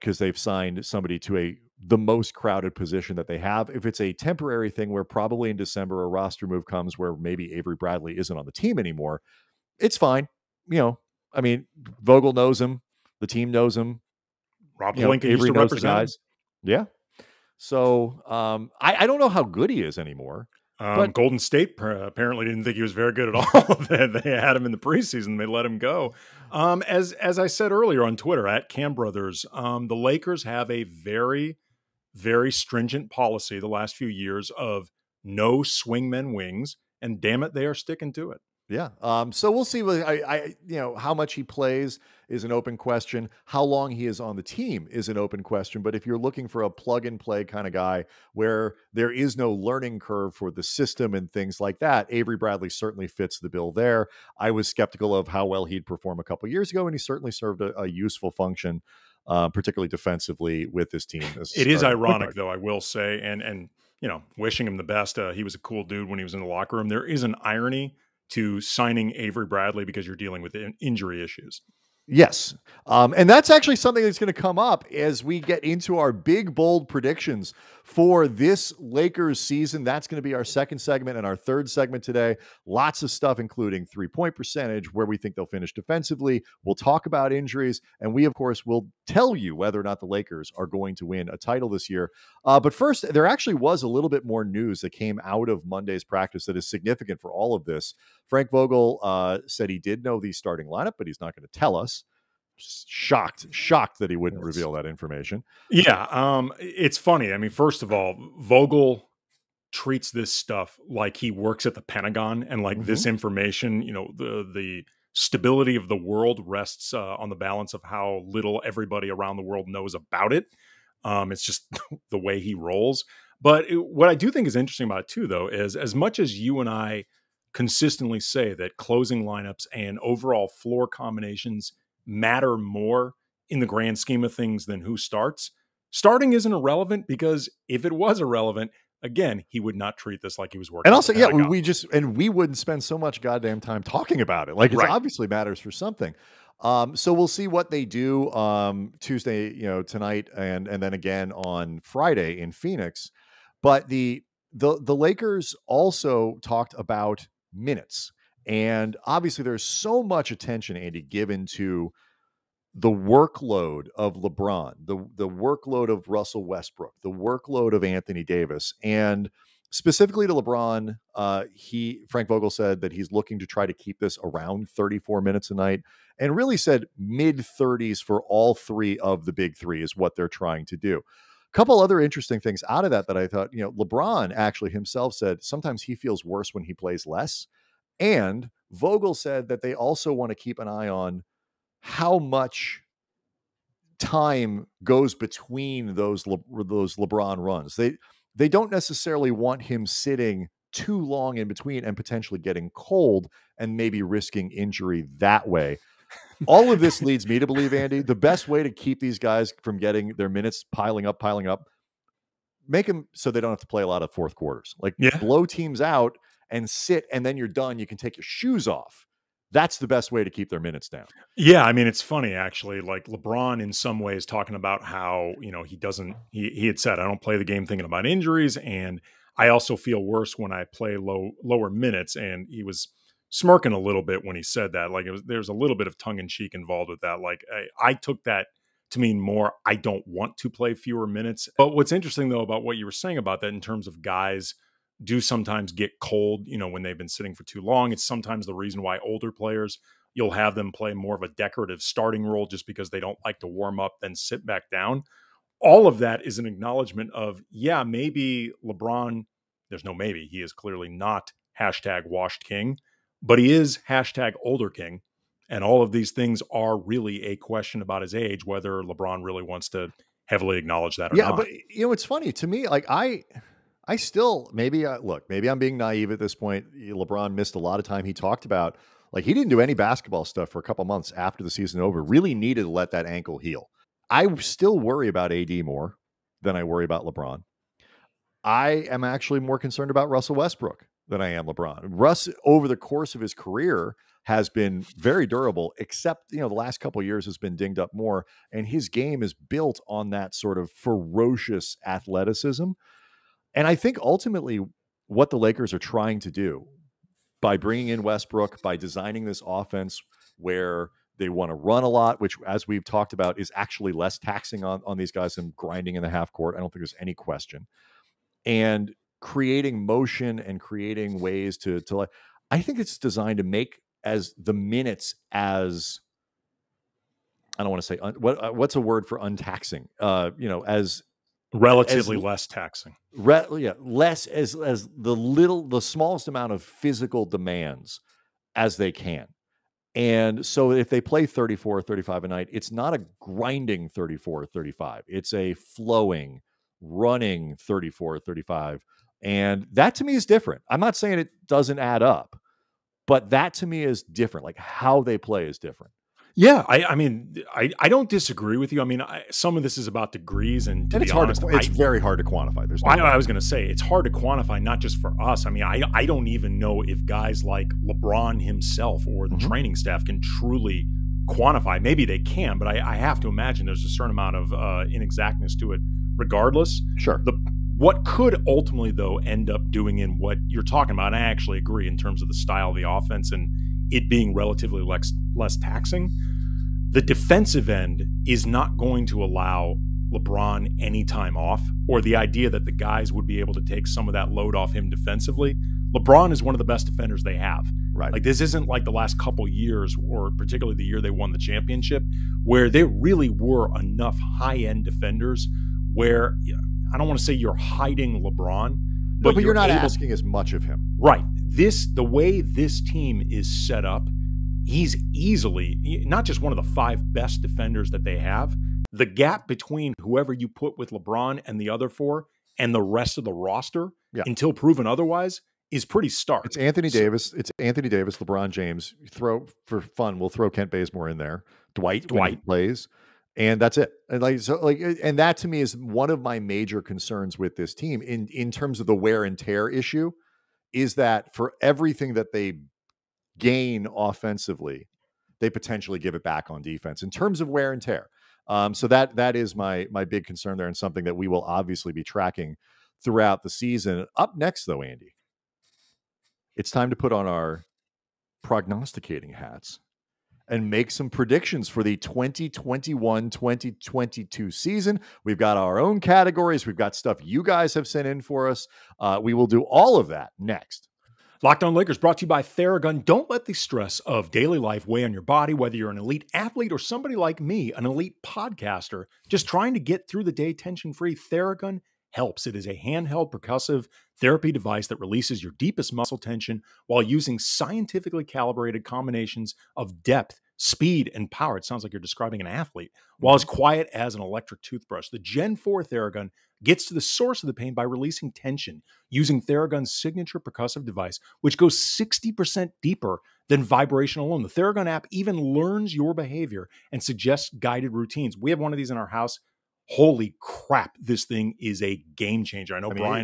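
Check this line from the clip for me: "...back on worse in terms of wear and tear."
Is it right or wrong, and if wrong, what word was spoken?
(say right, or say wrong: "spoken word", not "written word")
wrong: "defense", not "worse".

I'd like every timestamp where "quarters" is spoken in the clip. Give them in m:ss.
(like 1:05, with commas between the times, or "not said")
3:34.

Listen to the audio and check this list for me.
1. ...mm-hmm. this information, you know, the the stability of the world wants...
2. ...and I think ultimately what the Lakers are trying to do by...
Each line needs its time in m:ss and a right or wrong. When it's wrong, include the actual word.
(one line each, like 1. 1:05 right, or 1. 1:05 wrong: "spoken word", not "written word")
1. 1:52 wrong: "rests", not "wants"
2. 5:03 right.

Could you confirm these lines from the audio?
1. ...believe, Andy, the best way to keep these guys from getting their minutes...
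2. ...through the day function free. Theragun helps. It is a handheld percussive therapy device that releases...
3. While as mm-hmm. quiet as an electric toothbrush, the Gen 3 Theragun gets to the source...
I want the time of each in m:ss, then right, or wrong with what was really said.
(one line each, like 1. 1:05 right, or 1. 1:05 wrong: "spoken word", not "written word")
1. 3:27 right
2. 8:00 wrong: "tension", not "function"
3. 8:13 wrong: "4", not "3".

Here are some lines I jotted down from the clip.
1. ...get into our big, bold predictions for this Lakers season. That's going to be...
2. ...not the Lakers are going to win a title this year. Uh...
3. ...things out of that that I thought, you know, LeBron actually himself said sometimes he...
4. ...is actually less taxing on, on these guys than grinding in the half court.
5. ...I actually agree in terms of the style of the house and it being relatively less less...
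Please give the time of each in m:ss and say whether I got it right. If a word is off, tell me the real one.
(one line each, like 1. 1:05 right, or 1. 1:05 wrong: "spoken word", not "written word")
1. 1:15 right
2. 1:29 right
3. 3:02 right
4. 5:13 right
5. 6:21 wrong: "offense", not "house".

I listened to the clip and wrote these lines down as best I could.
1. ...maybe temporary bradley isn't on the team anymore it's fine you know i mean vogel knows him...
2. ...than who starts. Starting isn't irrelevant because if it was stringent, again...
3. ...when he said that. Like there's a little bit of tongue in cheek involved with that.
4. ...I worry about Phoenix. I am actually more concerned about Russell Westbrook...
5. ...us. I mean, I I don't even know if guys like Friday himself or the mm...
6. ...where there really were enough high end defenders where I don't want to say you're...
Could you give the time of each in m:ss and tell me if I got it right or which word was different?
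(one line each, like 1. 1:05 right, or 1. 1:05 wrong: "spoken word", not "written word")
1. 0:07 wrong: "avery", not "temporary"
2. 2:14 wrong: "irrelevant", not "stringent"
3. 3:54 right
4. 4:46 wrong: "LeBron", not "Phoenix"
5. 6:05 wrong: "LeBron", not "Friday"
6. 6:42 right.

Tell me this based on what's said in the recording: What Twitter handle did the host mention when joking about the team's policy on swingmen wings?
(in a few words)
Kam Brothers.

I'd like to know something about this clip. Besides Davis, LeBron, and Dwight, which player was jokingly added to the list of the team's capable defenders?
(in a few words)
Kent Bazemore.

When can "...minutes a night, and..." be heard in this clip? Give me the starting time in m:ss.
2:55.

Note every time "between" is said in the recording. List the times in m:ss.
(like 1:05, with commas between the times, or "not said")
3:15, 3:21, 6:59.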